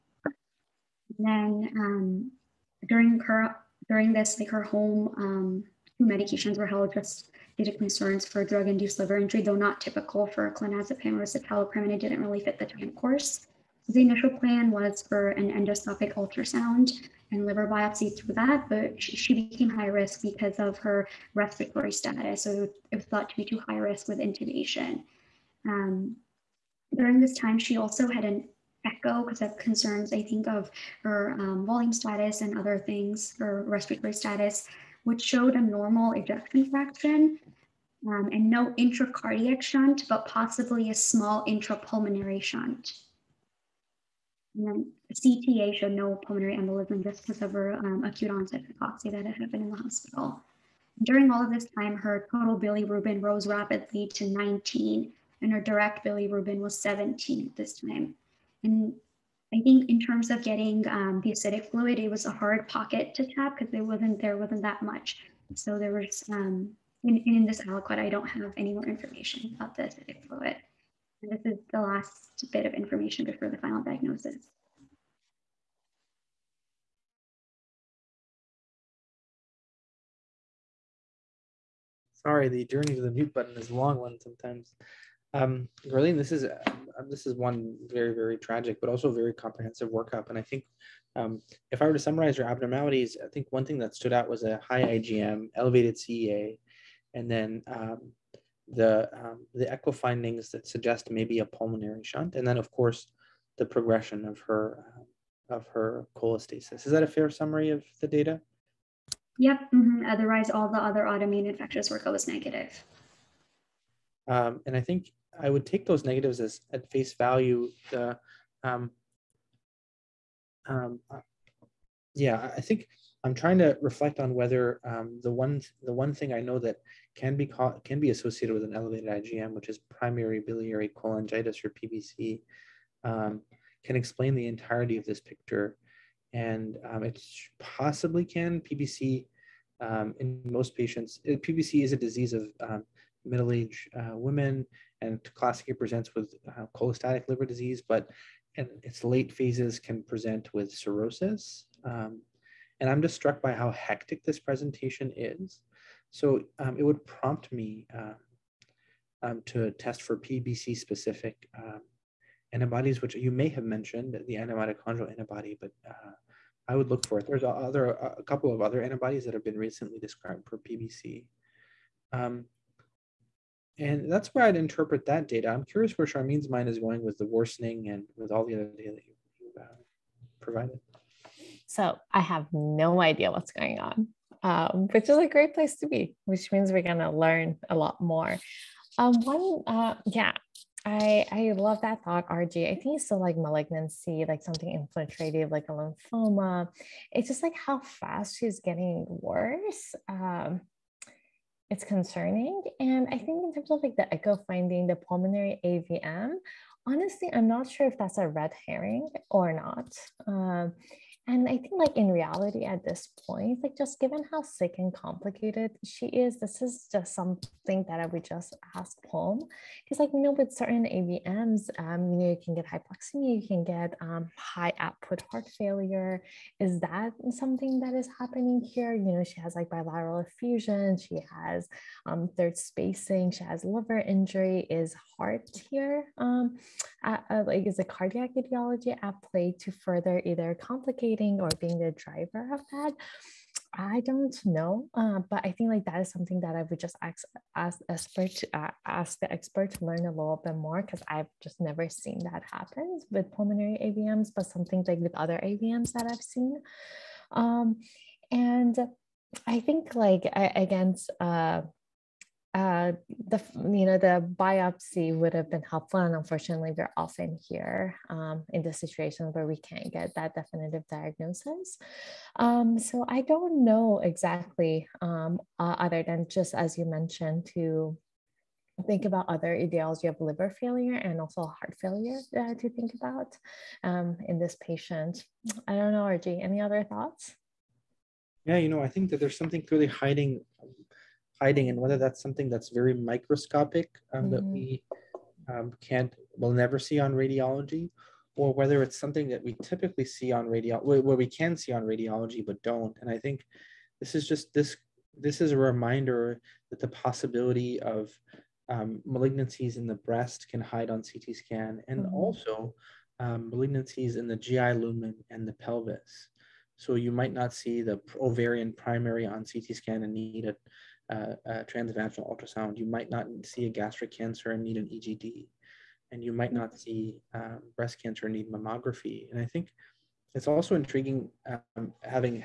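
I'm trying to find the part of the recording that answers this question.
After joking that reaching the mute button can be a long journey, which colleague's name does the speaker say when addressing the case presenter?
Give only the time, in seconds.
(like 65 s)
85 s.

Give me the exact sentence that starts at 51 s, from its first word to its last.
During all of this time, her total bilirubin rose rapidly to 19, and her direct bilirubin was 17 at this time.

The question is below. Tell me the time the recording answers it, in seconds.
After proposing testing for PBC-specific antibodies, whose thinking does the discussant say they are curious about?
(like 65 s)
176 s.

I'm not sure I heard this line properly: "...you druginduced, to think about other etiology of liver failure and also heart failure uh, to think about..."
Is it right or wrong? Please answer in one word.
wrong.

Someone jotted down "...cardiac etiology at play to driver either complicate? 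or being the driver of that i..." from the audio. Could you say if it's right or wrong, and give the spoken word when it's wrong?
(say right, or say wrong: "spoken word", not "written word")
wrong: "further", not "driver".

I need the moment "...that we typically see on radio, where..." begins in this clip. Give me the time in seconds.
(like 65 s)
299 s.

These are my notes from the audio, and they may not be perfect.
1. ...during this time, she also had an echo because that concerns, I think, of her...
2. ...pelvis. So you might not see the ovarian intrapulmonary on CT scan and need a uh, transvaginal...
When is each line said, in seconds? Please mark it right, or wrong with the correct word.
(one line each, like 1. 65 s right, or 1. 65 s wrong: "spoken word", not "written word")
1. 26 s right
2. 315 s wrong: "primary", not "intrapulmonary".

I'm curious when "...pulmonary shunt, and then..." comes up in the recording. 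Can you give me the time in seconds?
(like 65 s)
101 s.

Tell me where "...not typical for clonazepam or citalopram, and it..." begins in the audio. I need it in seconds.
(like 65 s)
9 s.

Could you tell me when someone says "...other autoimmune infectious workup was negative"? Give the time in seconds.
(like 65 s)
110 s.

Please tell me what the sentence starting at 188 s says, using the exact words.
Um, one, uh, yeah, I, I love that thought, RG.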